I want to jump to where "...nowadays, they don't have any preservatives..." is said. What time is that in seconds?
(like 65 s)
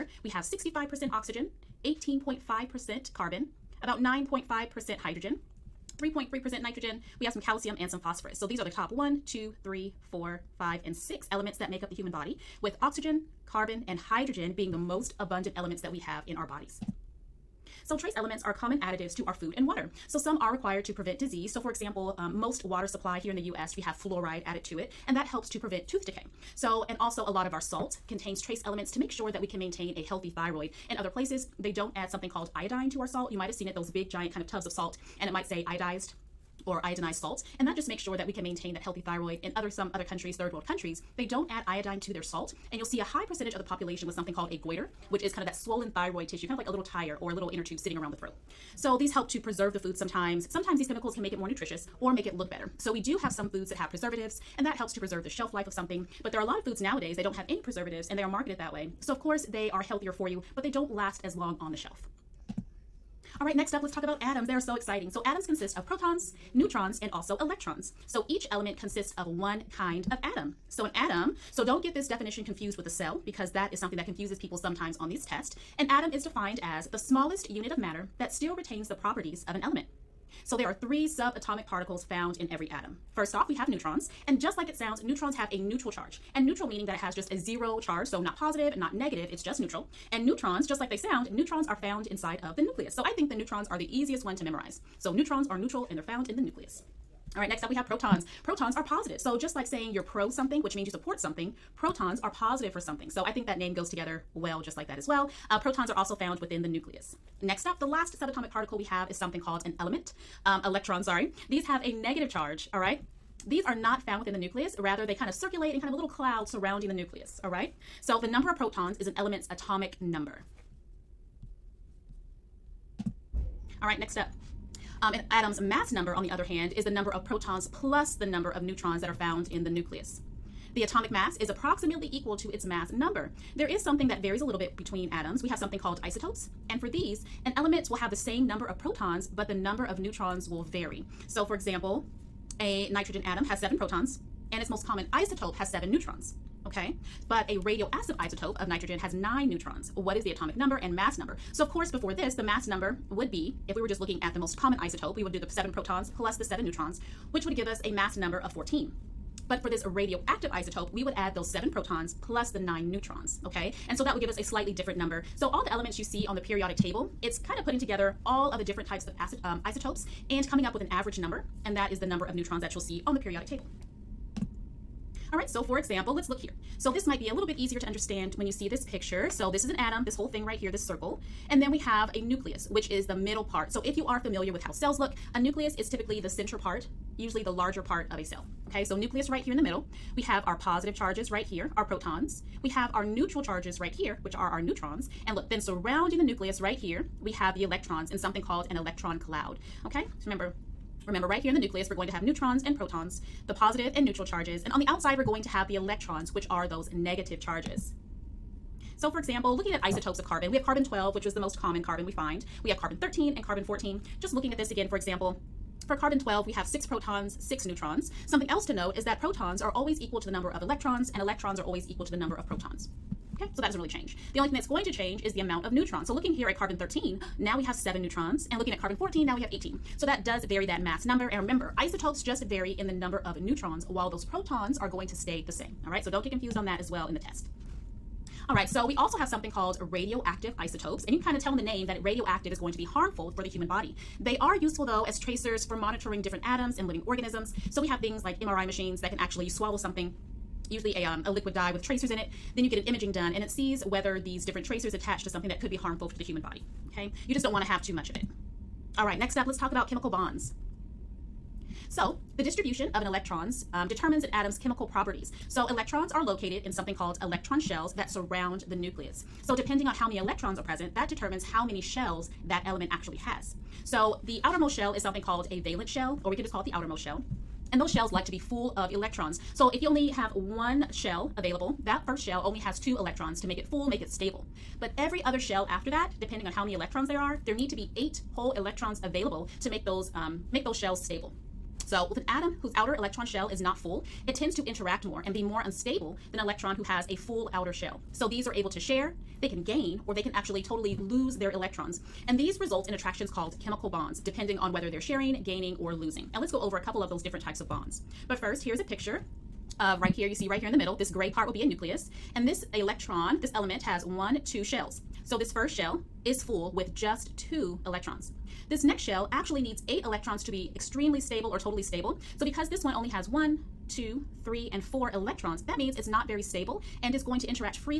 56 s.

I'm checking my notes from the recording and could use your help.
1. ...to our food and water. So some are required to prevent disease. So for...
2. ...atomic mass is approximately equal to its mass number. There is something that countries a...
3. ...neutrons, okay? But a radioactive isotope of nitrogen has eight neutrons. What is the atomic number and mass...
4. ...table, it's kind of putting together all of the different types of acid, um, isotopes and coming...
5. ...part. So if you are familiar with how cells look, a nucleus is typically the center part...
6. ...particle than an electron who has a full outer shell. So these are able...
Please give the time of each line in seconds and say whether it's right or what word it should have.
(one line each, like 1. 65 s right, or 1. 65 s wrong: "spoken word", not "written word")
1. 19 s right
2. 130 s wrong: "varies", not "countries"
3. 145 s wrong: "nine", not "eight"
4. 166 s right
5. 183 s right
6. 295 s wrong: "unstable", not "particle".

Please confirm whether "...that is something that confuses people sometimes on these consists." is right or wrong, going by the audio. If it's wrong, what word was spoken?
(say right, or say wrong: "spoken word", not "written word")
wrong: "tests", not "consists".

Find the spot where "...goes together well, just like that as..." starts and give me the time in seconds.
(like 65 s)
103 s.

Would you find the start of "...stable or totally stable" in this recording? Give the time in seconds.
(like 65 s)
321 s.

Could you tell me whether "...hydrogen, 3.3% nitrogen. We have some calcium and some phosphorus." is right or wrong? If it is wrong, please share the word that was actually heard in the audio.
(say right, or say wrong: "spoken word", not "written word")
right.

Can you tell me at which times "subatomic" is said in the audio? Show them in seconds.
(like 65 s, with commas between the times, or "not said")
81 s, 108 s.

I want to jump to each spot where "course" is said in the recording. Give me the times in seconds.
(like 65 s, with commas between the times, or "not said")
59 s, 151 s.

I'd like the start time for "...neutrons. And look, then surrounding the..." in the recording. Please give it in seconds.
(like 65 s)
194 s.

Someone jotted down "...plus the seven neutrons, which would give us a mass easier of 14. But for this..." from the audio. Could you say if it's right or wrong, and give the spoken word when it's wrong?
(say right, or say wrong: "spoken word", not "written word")
wrong: "number", not "easier".